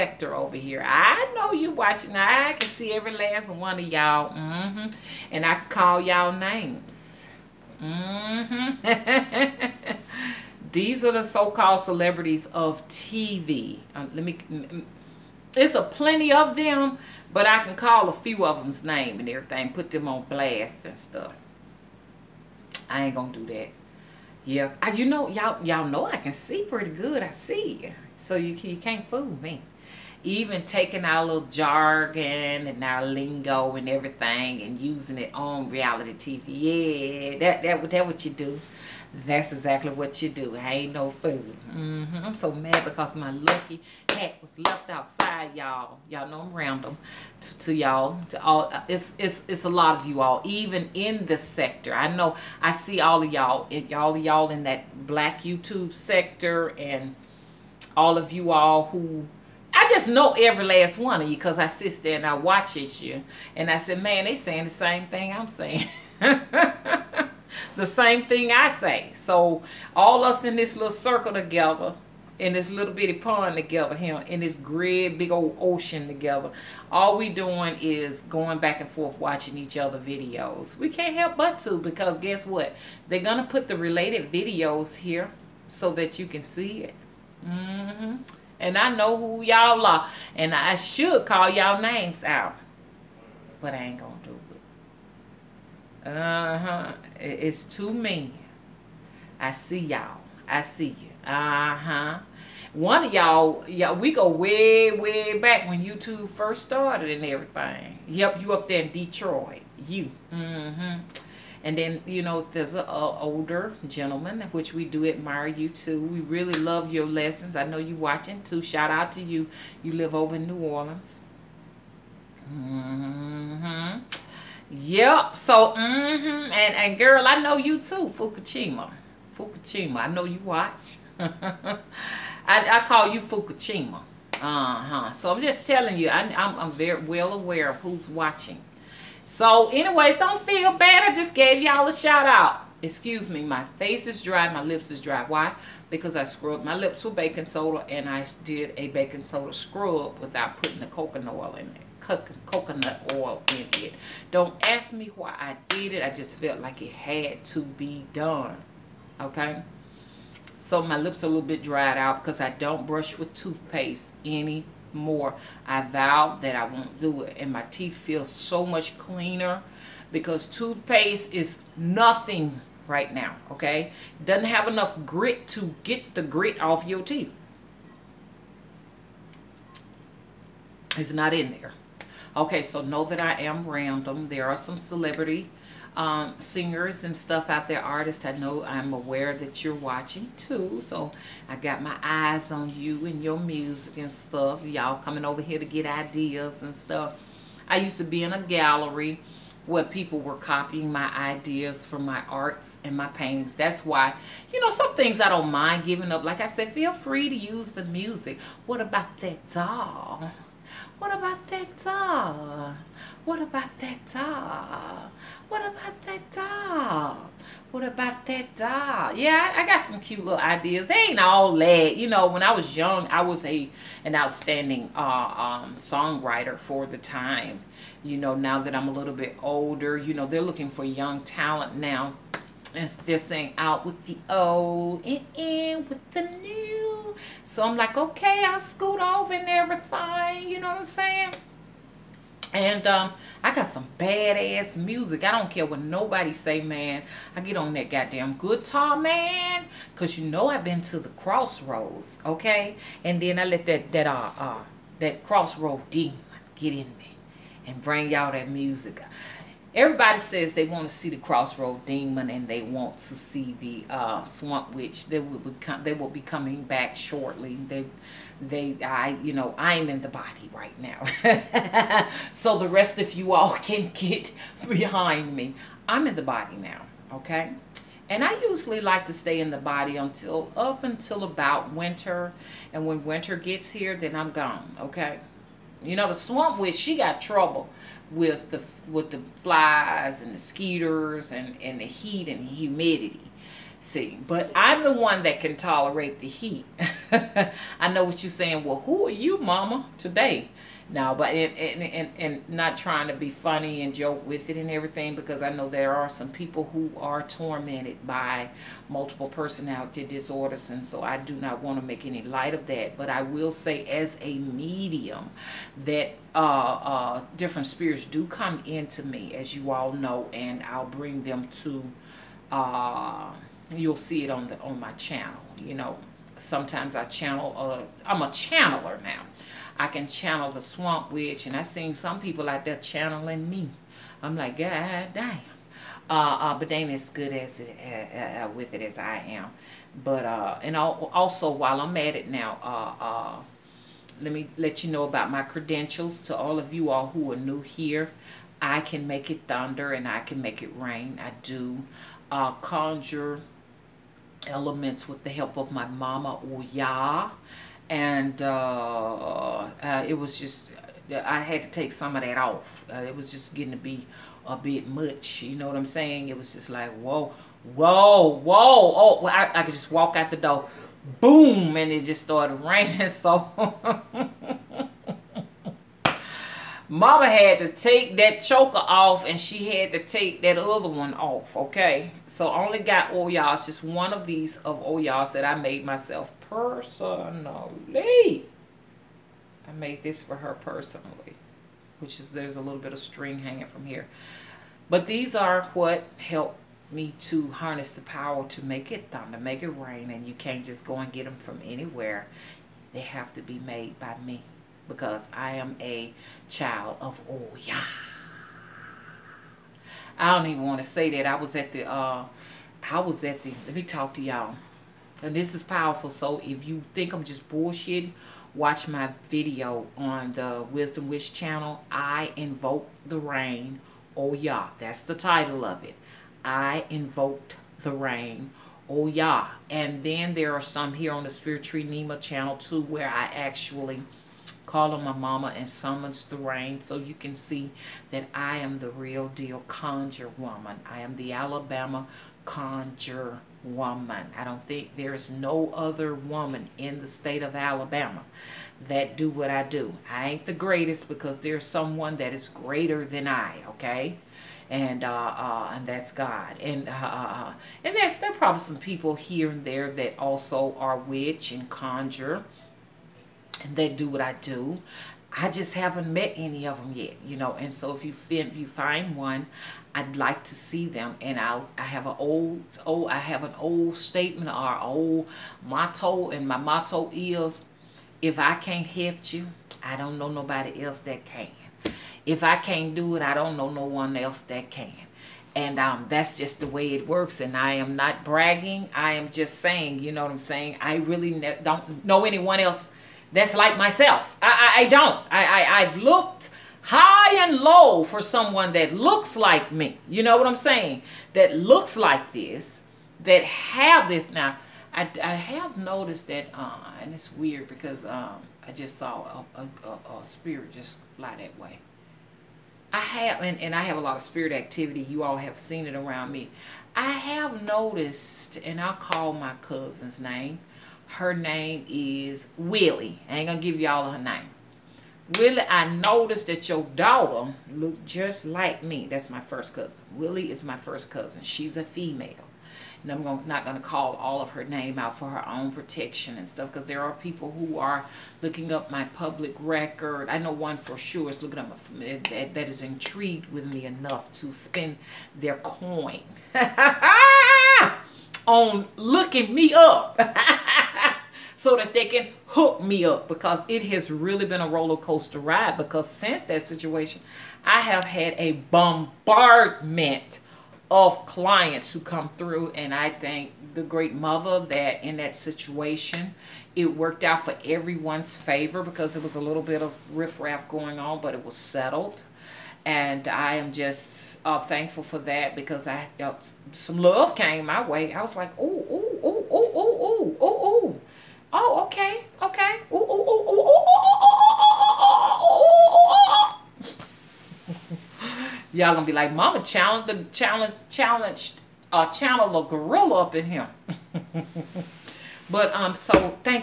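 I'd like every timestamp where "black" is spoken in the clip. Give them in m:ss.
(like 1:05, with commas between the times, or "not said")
0:55.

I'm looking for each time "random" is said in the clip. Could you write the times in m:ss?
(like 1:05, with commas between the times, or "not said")
0:46, 3:03.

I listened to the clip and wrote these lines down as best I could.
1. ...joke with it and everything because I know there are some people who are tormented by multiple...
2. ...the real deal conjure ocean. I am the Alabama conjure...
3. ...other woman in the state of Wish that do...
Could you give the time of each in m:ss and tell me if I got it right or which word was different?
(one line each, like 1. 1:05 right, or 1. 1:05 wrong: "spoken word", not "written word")
1. 5:03 right
2. 7:18 wrong: "woman", not "ocean"
3. 7:25 wrong: "Alabama", not "Wish".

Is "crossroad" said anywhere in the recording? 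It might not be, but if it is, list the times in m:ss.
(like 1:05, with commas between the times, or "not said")
4:11, 4:15, 4:21.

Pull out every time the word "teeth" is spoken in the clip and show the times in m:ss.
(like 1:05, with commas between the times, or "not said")
2:47, 2:57.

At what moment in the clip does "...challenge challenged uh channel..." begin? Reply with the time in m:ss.
9:50.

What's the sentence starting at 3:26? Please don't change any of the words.
Like I said, feel free to use the music.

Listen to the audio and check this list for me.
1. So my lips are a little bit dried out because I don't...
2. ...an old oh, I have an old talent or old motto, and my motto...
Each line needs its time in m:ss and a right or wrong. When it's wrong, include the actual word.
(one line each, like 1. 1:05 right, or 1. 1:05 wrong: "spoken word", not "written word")
1. 2:40 right
2. 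7:52 wrong: "statement", not "talent".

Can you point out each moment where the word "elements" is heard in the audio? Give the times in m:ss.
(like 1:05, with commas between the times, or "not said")
5:54.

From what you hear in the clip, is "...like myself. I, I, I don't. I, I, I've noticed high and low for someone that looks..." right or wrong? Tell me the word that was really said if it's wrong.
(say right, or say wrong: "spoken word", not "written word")
wrong: "looked", not "noticed".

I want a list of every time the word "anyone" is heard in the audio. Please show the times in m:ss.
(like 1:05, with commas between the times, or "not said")
8:12.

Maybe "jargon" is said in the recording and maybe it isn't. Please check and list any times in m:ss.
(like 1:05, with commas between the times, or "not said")
0:31.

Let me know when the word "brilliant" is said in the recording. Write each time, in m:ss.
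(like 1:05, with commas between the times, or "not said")
not said.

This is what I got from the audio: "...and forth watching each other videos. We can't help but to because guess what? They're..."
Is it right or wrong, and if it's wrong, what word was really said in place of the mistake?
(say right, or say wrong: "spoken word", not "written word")
right.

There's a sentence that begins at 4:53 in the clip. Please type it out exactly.
See, but I'm the one that can tolerate the heat.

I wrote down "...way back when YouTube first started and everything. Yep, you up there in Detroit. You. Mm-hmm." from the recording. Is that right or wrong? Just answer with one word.
right.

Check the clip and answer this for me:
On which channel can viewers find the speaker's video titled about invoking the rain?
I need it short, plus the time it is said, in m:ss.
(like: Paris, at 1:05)
Wisdom Wish, at 7:00.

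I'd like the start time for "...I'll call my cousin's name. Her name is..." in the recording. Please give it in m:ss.
8:38.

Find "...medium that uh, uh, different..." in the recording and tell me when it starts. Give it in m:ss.
5:14.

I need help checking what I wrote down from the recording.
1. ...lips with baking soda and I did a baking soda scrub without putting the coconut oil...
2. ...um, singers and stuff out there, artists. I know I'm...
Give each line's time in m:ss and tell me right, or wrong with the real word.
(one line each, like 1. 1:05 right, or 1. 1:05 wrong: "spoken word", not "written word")
1. 2:26 right
2. 3:05 right.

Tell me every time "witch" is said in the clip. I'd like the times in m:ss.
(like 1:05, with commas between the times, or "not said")
4:24, 4:46, 5:31, 7:40.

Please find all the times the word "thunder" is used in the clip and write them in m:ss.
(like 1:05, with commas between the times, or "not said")
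5:49, 6:39.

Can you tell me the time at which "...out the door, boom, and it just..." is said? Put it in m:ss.
6:10.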